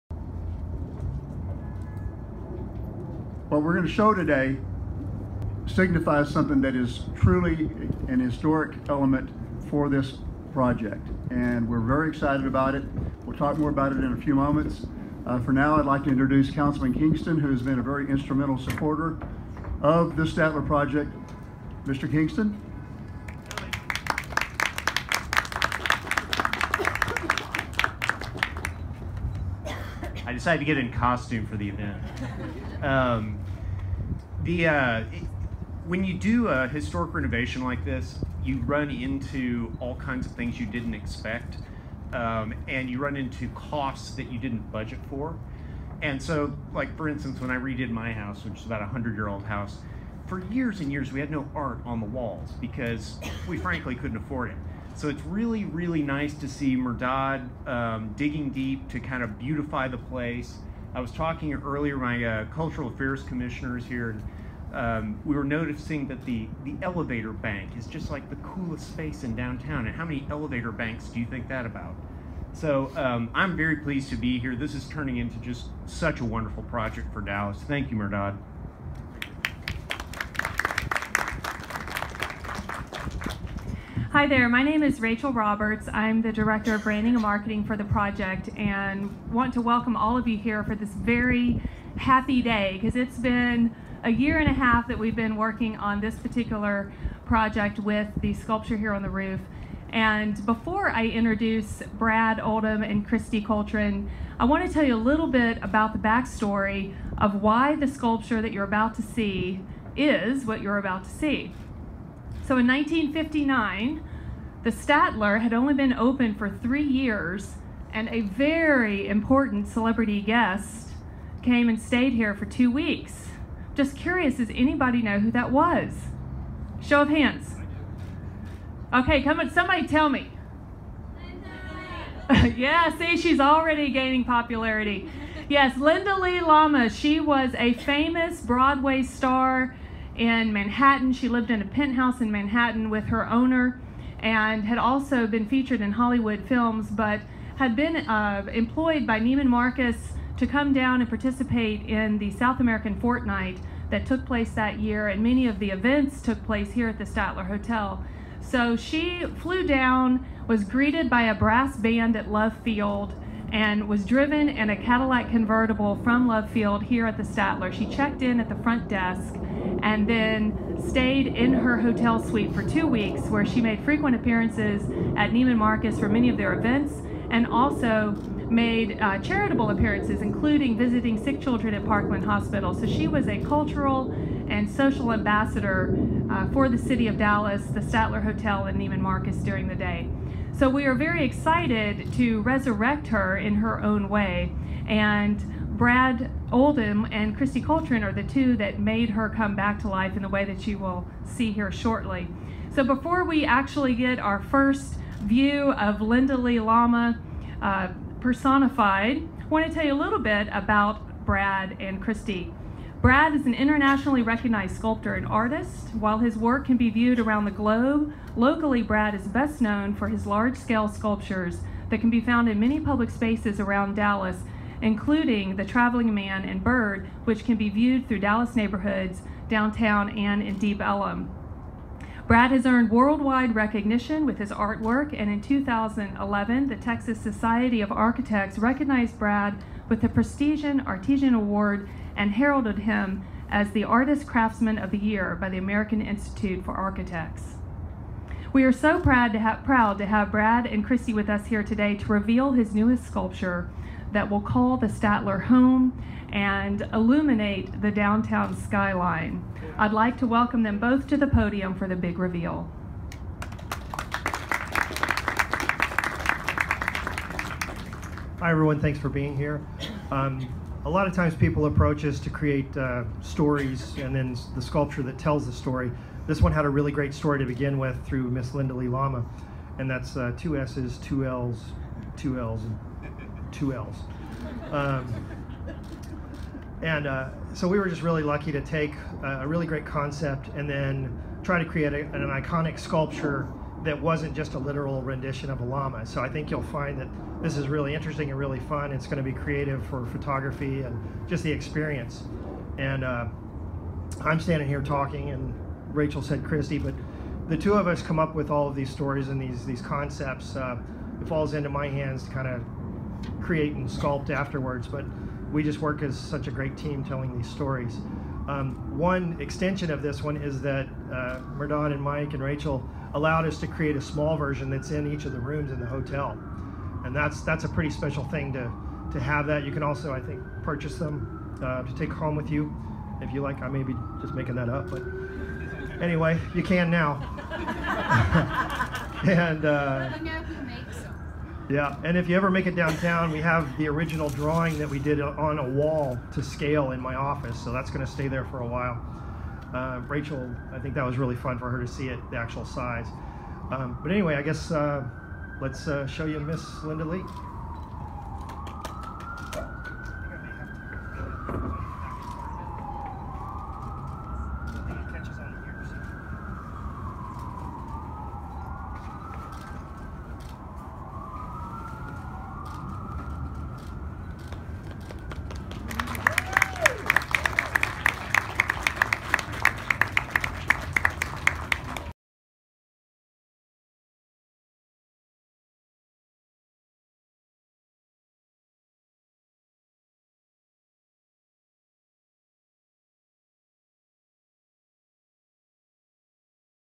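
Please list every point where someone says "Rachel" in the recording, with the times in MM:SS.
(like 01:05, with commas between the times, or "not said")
01:24, 05:05, 05:22, 05:50.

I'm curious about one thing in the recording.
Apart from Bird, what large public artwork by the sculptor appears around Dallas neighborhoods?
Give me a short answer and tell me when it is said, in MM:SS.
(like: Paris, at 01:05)
The Traveling Man, at 03:45.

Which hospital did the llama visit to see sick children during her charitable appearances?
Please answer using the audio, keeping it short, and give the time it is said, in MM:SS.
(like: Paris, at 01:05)
Parkland Hospital, at 03:01.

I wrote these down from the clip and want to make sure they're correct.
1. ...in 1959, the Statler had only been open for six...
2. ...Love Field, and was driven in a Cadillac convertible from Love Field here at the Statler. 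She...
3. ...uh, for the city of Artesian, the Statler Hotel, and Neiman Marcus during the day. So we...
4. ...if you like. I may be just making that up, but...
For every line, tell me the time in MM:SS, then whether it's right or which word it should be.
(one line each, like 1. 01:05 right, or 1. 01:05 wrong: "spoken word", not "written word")
1. 01:52 wrong: "three", not "six"
2. 02:42 right
3. 03:06 wrong: "Dallas", not "Artesian"
4. 05:33 right.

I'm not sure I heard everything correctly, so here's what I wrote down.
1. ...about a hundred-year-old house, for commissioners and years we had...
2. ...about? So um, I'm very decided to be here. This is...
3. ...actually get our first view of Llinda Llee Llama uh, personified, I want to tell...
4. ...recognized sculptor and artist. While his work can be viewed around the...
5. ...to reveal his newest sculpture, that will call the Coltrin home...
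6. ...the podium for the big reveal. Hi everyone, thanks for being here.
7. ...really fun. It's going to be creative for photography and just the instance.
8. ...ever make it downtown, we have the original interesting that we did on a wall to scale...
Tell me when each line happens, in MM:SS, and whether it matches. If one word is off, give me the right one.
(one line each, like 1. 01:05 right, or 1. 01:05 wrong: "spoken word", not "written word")
1. 00:48 wrong: "years", not "commissioners"
2. 01:11 wrong: "pleased", not "decided"
3. 03:23 right
4. 03:34 right
5. 04:11 wrong: "Statler", not "Coltrin"
6. 04:21 right
7. 04:58 wrong: "experience", not "instance"
8. 05:42 wrong: "drawing", not "interesting".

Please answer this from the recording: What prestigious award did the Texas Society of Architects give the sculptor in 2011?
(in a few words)
Artesian Award.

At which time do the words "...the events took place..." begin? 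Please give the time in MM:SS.
02:35.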